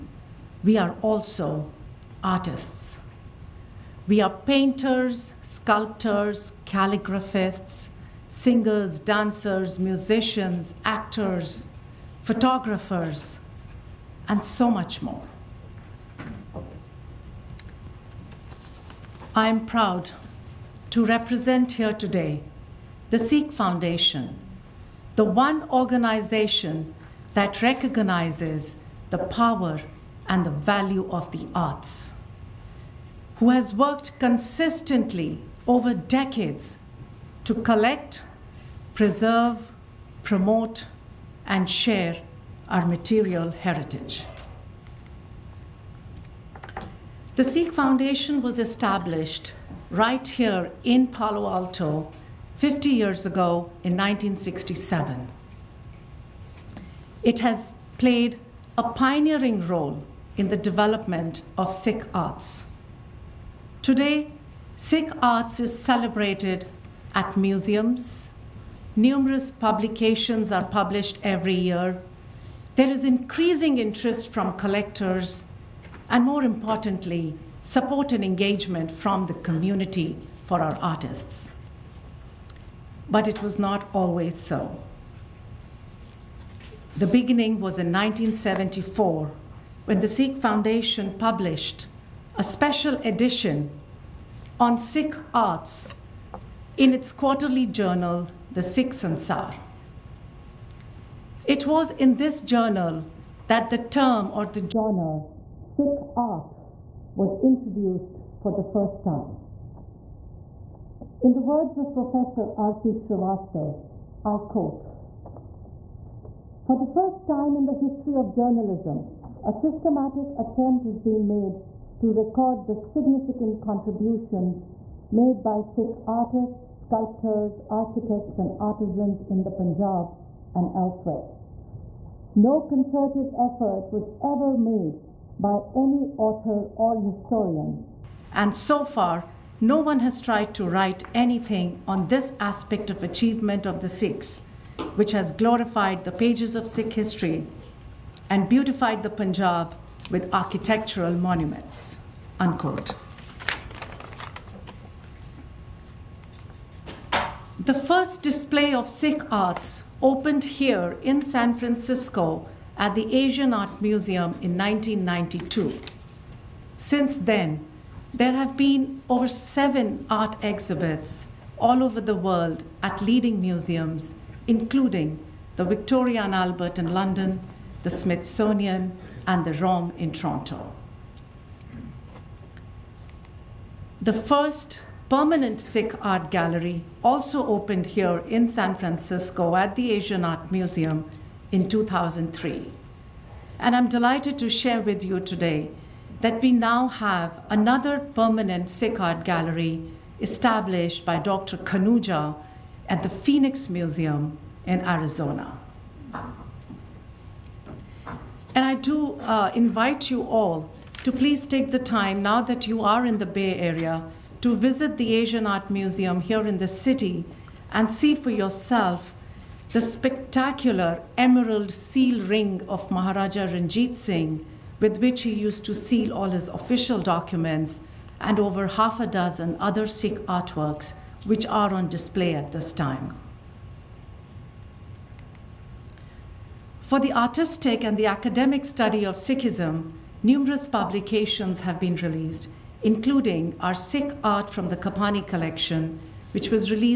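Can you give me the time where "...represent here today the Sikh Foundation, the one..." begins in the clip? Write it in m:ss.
0:21.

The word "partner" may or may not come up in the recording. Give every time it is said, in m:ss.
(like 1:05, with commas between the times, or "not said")
not said.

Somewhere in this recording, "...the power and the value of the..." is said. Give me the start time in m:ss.
0:29.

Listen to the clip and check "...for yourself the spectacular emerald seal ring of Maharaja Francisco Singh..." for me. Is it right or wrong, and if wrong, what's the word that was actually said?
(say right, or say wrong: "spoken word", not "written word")
wrong: "Ranjit", not "Francisco".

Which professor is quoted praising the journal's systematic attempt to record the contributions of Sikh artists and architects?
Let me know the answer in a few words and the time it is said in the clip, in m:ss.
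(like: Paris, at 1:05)
R.P. Srivastav, at 1:52.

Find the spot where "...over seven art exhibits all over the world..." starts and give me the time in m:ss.
2:49.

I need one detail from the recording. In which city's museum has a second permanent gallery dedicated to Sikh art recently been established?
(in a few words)
Phoenix.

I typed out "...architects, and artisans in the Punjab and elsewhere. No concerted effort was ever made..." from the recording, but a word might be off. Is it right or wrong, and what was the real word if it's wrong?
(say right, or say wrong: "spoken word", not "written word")
right.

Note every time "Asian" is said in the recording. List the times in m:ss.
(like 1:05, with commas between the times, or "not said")
2:43, 3:09, 3:35.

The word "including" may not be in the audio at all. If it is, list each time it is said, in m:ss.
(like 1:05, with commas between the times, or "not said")
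2:54, 4:02.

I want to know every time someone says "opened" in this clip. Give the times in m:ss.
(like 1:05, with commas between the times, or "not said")
2:40, 3:07.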